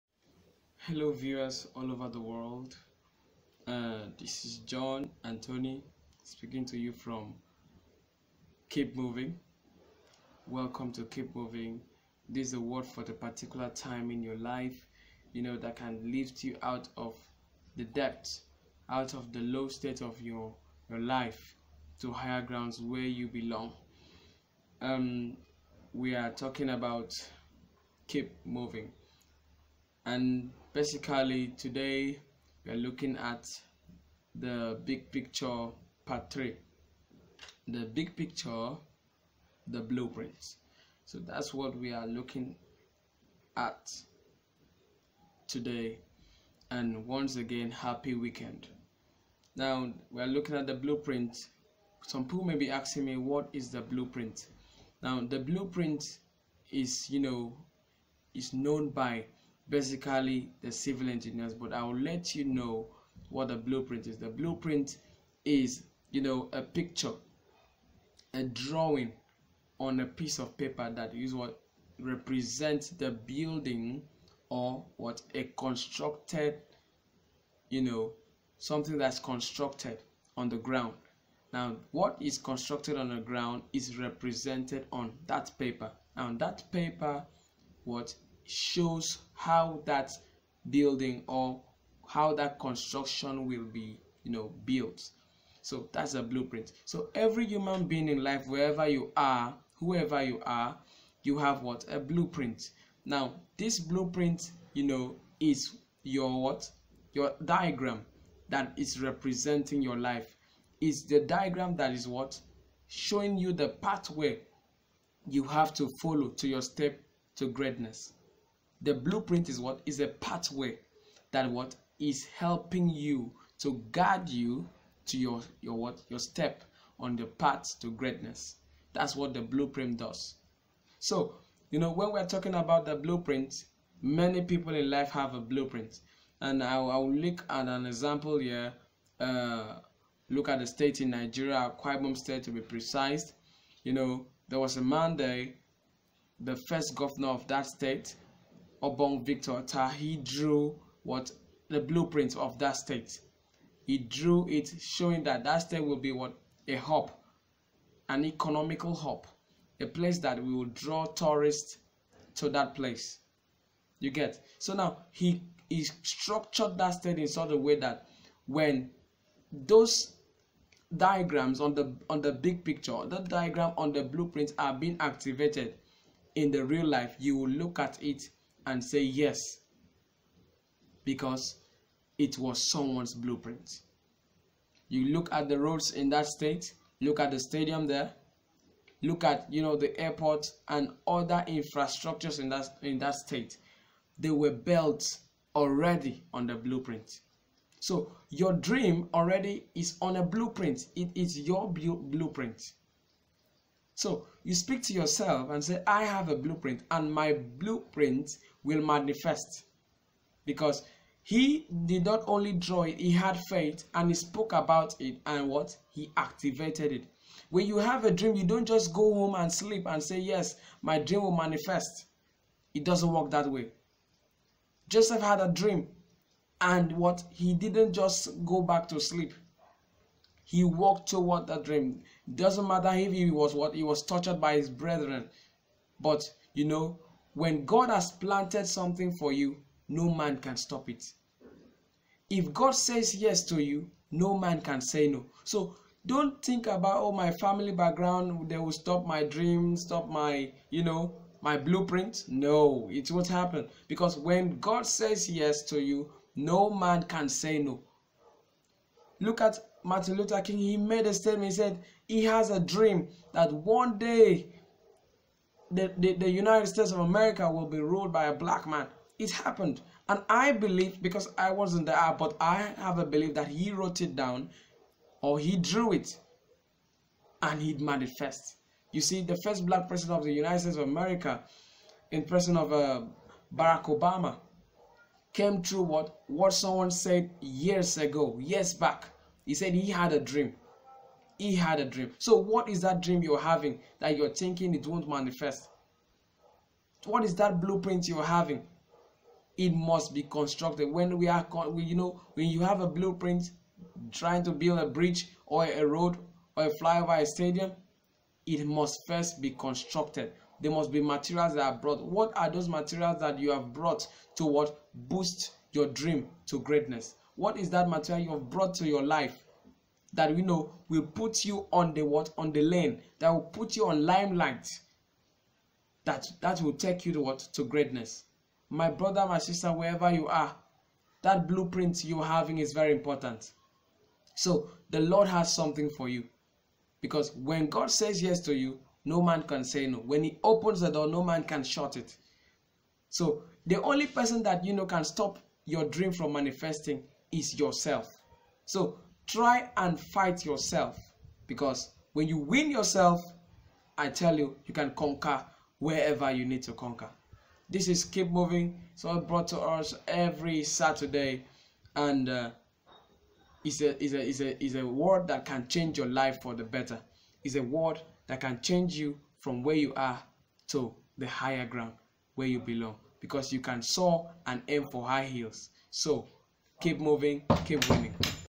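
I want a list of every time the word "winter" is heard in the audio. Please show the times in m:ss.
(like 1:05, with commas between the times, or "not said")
not said.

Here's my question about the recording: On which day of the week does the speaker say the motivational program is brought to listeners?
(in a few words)
Saturday.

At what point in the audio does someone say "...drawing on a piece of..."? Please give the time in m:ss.
1:08.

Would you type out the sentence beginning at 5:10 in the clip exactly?
There must be materials that are brought.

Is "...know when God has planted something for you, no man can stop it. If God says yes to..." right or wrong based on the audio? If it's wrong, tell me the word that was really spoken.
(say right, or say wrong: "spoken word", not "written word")
right.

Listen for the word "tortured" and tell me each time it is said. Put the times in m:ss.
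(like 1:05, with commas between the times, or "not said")
3:54.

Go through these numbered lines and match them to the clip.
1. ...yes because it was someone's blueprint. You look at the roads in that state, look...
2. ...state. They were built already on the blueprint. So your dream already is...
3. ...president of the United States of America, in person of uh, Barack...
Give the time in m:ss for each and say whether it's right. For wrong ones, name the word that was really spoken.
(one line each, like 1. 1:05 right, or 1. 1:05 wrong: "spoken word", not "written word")
1. 2:59 right
2. 3:13 right
3. 4:39 right.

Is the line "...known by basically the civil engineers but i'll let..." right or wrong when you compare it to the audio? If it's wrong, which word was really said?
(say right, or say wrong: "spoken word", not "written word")
right.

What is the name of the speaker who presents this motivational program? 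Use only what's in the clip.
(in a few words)
John Anthony.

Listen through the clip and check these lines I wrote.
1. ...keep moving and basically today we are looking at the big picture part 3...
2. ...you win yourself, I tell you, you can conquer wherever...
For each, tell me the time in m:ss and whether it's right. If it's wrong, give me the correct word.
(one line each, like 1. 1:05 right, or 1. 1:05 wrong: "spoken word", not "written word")
1. 0:28 right
2. 5:52 right.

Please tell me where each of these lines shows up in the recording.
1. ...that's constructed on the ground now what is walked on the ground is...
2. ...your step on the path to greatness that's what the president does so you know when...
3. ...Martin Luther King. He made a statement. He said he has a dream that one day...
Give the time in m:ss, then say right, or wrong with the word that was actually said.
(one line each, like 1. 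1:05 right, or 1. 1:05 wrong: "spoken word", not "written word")
1. 1:18 wrong: "constructed", not "walked"
2. 2:06 wrong: "blueprint", not "president"
3. 4:19 right.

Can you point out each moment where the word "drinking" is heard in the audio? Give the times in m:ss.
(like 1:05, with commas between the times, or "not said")
not said.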